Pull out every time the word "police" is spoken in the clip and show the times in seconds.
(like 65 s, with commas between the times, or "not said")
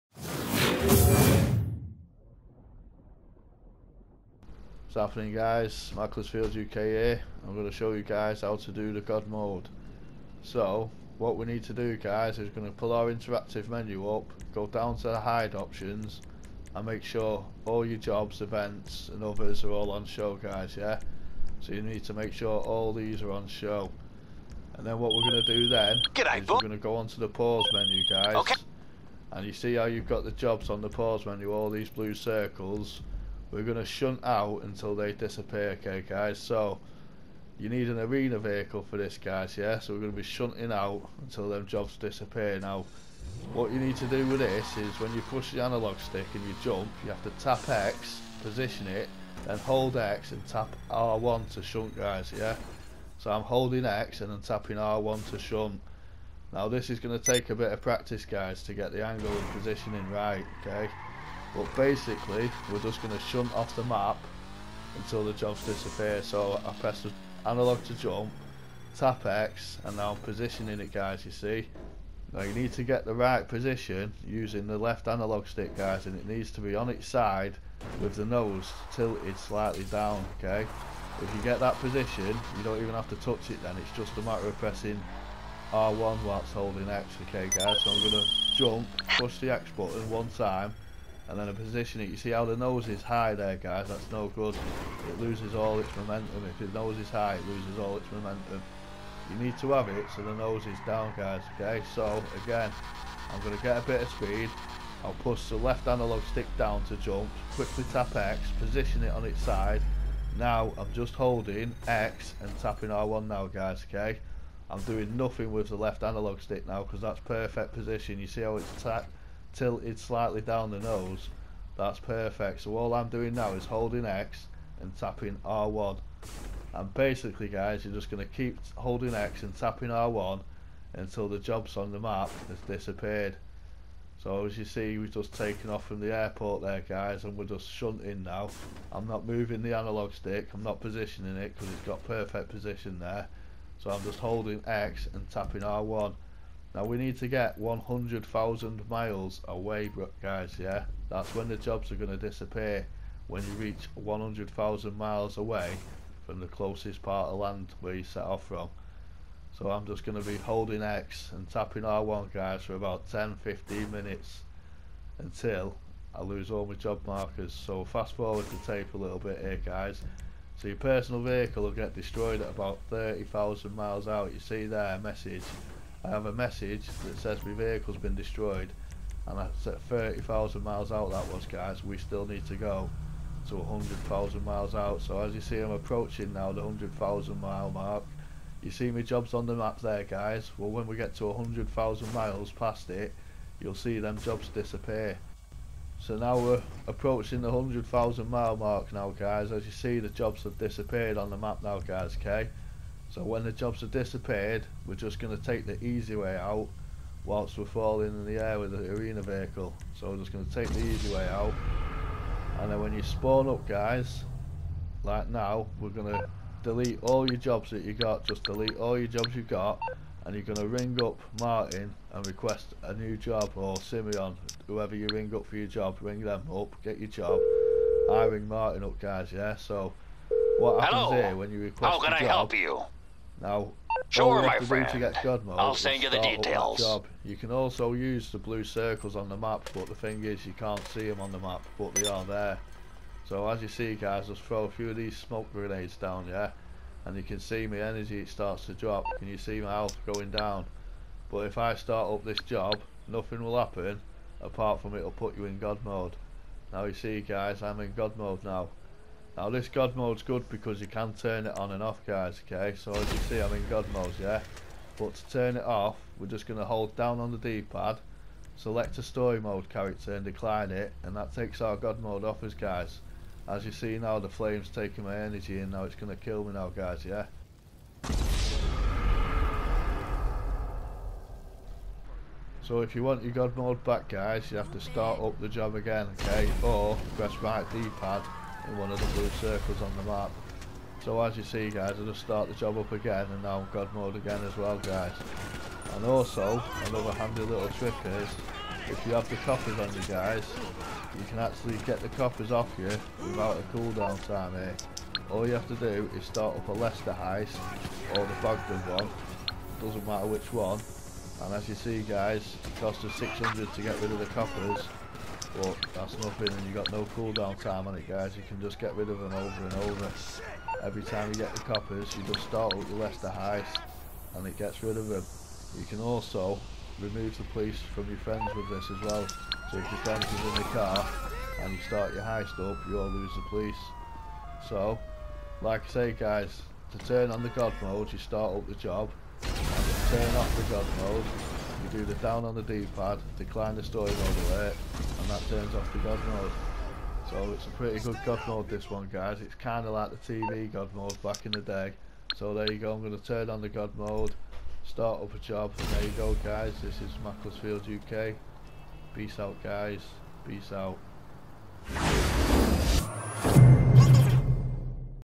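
327 s, 333 s.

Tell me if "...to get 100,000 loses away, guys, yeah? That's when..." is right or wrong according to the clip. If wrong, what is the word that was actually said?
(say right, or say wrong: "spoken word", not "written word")
wrong: "miles", not "loses".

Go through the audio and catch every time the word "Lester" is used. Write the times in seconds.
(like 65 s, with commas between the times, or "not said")
306 s, 322 s.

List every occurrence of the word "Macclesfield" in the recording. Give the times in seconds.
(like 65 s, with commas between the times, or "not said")
5 s, 357 s.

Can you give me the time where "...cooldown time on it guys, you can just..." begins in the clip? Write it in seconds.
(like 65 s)
317 s.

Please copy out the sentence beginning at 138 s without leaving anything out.
I'm not moving the analog stick.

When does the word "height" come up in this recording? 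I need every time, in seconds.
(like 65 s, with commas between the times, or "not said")
not said.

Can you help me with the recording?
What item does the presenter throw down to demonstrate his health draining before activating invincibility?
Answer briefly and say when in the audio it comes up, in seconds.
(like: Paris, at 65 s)
smoke grenades, at 245 s.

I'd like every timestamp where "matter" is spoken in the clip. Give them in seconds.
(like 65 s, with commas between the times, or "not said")
84 s, 310 s.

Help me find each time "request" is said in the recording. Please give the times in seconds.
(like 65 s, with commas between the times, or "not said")
222 s, 231 s.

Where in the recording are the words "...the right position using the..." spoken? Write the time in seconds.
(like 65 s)
73 s.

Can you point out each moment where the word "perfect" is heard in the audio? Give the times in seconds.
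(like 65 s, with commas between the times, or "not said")
117 s, 121 s, 142 s.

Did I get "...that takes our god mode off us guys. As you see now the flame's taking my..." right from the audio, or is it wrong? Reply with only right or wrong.
right.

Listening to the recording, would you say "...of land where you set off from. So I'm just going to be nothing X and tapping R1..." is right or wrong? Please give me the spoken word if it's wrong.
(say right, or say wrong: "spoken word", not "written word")
wrong: "holding", not "nothing".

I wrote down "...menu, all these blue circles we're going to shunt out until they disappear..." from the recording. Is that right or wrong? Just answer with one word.
right.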